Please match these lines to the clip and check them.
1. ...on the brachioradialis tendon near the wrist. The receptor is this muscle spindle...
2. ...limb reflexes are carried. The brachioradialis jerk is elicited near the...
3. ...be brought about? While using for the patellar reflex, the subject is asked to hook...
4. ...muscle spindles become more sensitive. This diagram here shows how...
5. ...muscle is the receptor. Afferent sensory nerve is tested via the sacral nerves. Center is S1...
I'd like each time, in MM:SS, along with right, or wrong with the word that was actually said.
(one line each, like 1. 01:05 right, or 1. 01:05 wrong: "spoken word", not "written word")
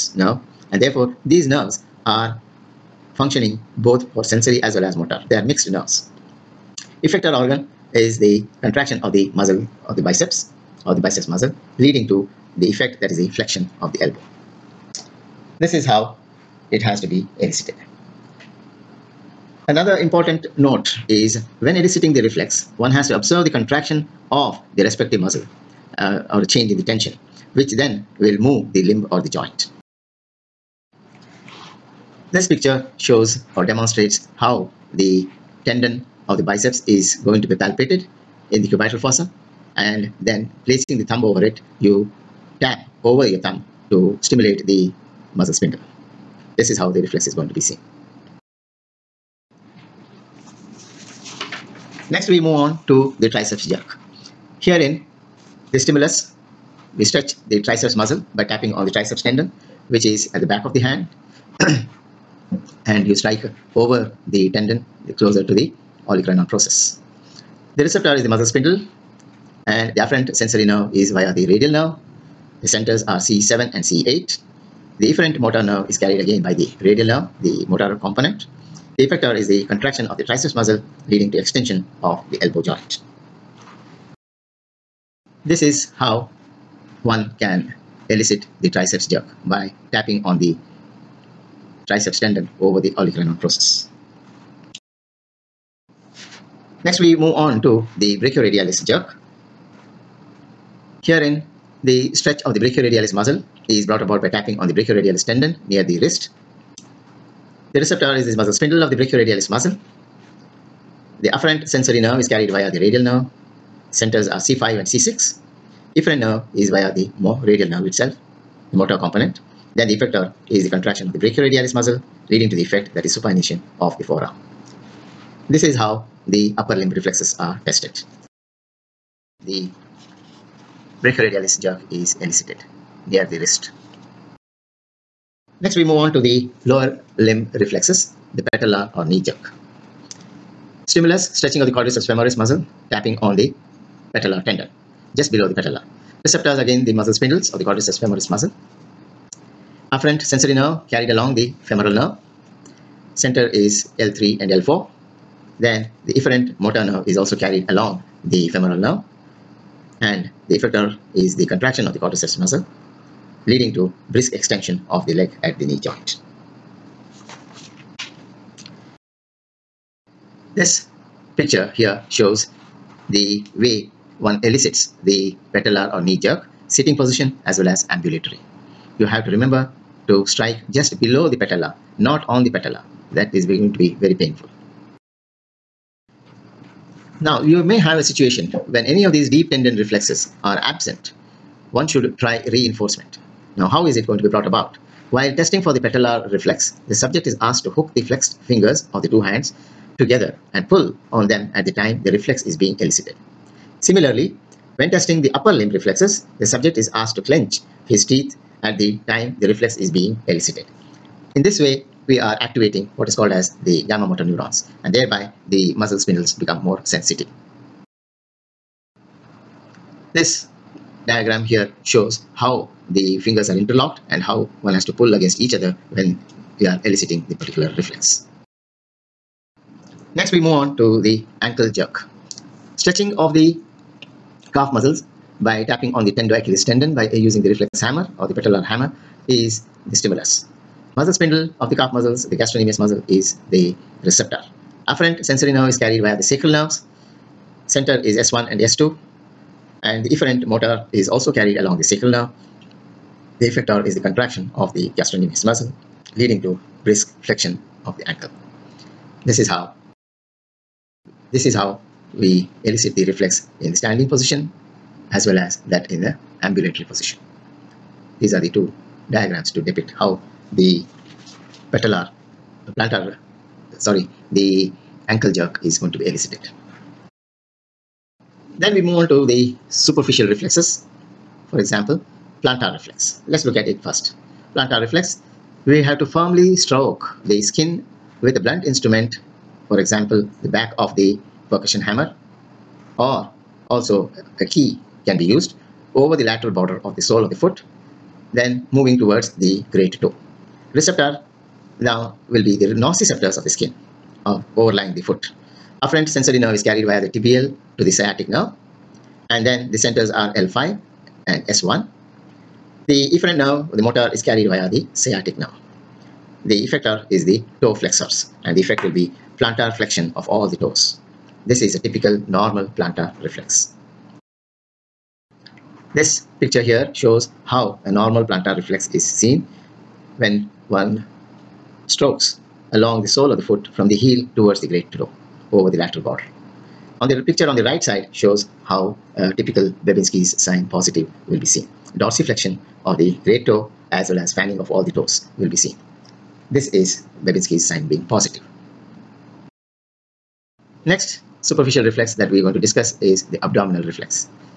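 1. 01:44 right
2. 02:06 wrong: "tested", not "carried"
3. 03:14 wrong: "testing", not "using"
4. 03:35 right
5. 04:02 wrong: "carried", not "tested".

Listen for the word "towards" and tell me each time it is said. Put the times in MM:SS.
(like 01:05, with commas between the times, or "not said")
04:58, 05:34.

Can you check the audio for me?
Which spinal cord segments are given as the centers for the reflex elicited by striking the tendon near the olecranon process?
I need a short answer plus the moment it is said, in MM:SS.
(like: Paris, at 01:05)
C7 and C8, at 01:13.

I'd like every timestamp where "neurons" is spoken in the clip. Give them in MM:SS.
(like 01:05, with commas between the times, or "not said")
03:34.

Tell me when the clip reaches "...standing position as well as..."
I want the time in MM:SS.
04:23.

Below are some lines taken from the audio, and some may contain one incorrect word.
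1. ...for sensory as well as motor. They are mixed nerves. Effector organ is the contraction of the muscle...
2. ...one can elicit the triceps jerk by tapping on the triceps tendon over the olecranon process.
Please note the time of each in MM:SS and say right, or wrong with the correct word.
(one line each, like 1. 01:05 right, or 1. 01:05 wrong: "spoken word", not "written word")
1. 00:04 right
2. 01:27 right.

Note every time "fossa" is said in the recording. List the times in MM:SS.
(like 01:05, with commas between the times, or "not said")
00:38.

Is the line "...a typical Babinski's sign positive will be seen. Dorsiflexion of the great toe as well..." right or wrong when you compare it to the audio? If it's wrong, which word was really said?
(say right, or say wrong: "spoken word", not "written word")
right.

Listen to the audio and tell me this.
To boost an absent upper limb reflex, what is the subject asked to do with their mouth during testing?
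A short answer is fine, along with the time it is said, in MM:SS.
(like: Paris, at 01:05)
Clench his teeth, at 03:27.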